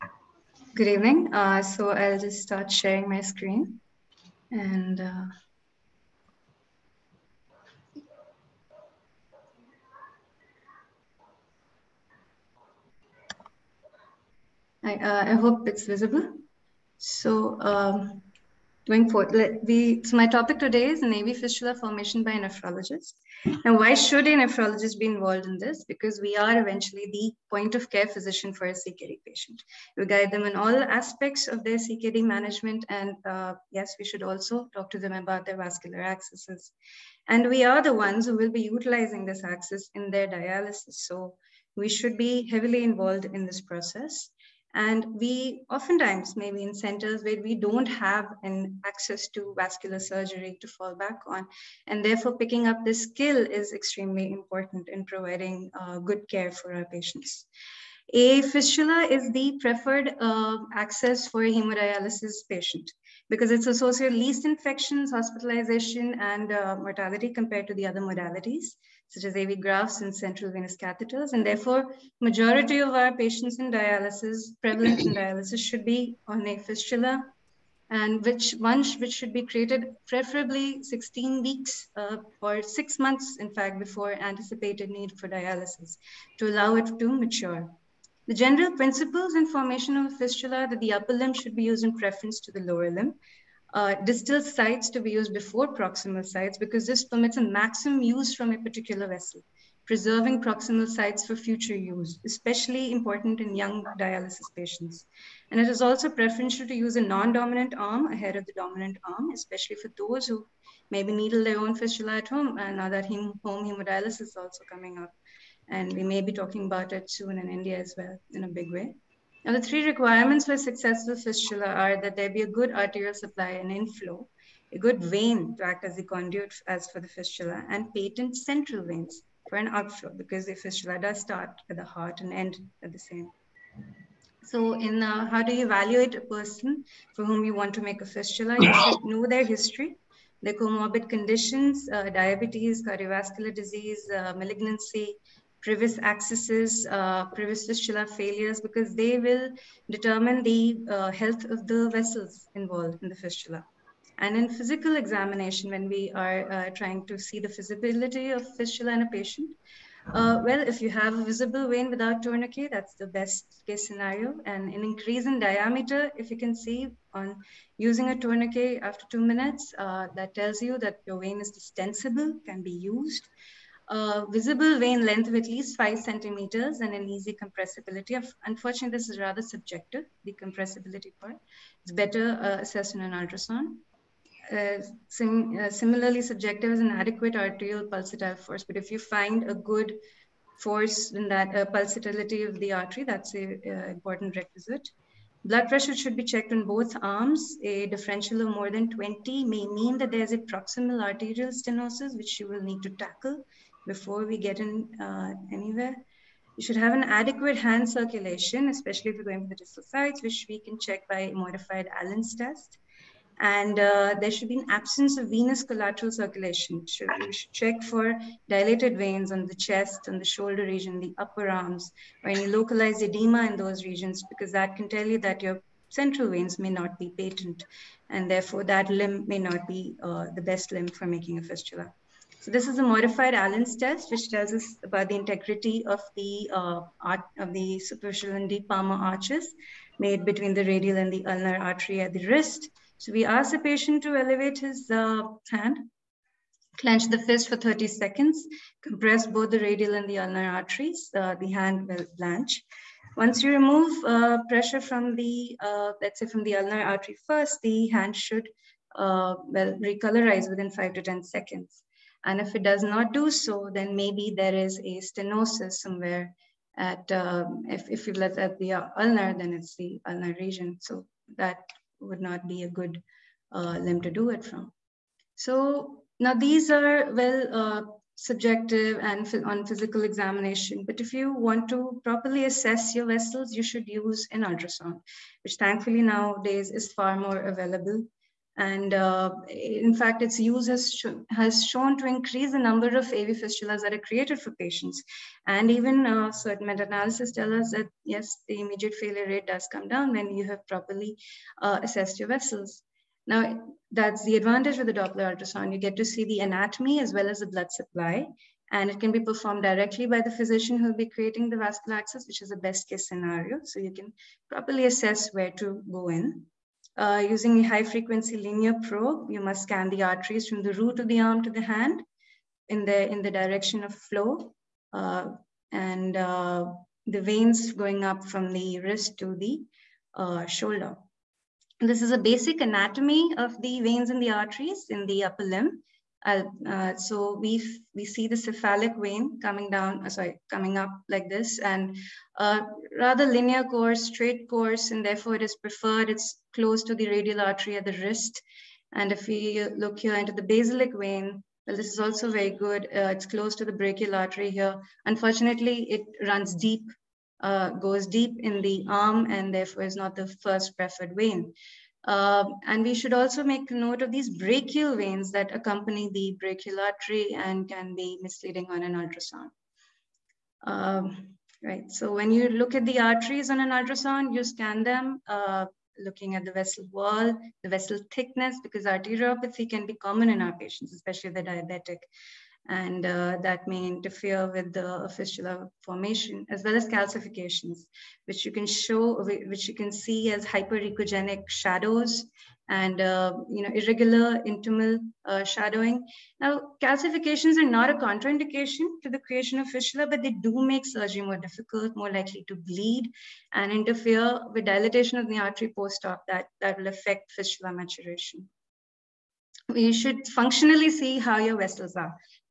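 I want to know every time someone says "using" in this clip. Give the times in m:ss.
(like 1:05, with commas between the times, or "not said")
2:47, 5:17.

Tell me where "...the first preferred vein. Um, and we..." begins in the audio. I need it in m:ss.
6:00.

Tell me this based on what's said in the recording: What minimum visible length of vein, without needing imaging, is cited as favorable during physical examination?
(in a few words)
5 centimeters.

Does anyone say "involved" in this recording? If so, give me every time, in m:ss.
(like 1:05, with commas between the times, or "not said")
0:25, 0:42, 2:32.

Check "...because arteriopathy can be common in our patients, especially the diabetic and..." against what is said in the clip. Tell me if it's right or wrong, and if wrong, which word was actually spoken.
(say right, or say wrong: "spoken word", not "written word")
right.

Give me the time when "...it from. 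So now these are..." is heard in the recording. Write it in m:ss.
4:34.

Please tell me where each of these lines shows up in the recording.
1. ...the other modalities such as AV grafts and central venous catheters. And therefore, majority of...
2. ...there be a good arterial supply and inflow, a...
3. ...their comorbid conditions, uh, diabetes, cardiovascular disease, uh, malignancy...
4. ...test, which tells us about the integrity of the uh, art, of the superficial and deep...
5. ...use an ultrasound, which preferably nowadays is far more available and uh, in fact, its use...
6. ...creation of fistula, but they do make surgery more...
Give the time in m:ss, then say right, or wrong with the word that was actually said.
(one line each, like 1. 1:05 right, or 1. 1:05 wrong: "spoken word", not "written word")
1. 1:07 right
2. 2:02 right
3. 2:20 right
4. 3:53 right
5. 4:43 wrong: "thankfully", not "preferably"
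6. 6:39 right.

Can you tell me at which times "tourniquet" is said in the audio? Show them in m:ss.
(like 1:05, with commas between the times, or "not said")
2:42, 2:48.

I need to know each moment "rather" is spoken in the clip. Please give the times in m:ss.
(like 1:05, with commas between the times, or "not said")
2:59, 5:42.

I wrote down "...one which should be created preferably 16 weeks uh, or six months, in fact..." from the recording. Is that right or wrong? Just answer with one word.
right.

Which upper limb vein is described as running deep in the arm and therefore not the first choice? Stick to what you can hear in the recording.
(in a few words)
basilic vein.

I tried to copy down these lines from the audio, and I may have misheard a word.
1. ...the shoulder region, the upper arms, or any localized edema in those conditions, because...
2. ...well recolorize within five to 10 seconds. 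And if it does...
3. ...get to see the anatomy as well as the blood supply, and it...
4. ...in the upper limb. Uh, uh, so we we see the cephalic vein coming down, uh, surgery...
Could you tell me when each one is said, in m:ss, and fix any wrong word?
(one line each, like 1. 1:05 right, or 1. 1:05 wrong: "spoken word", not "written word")
1. 3:40 wrong: "regions", not "conditions"
2. 4:19 right
3. 5:05 right
4. 5:34 wrong: "sorry", not "surgery".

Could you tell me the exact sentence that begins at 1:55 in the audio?
And we may be talking about it soon in India as well in a big way.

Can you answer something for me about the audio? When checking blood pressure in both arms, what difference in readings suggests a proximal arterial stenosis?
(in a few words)
more than 20.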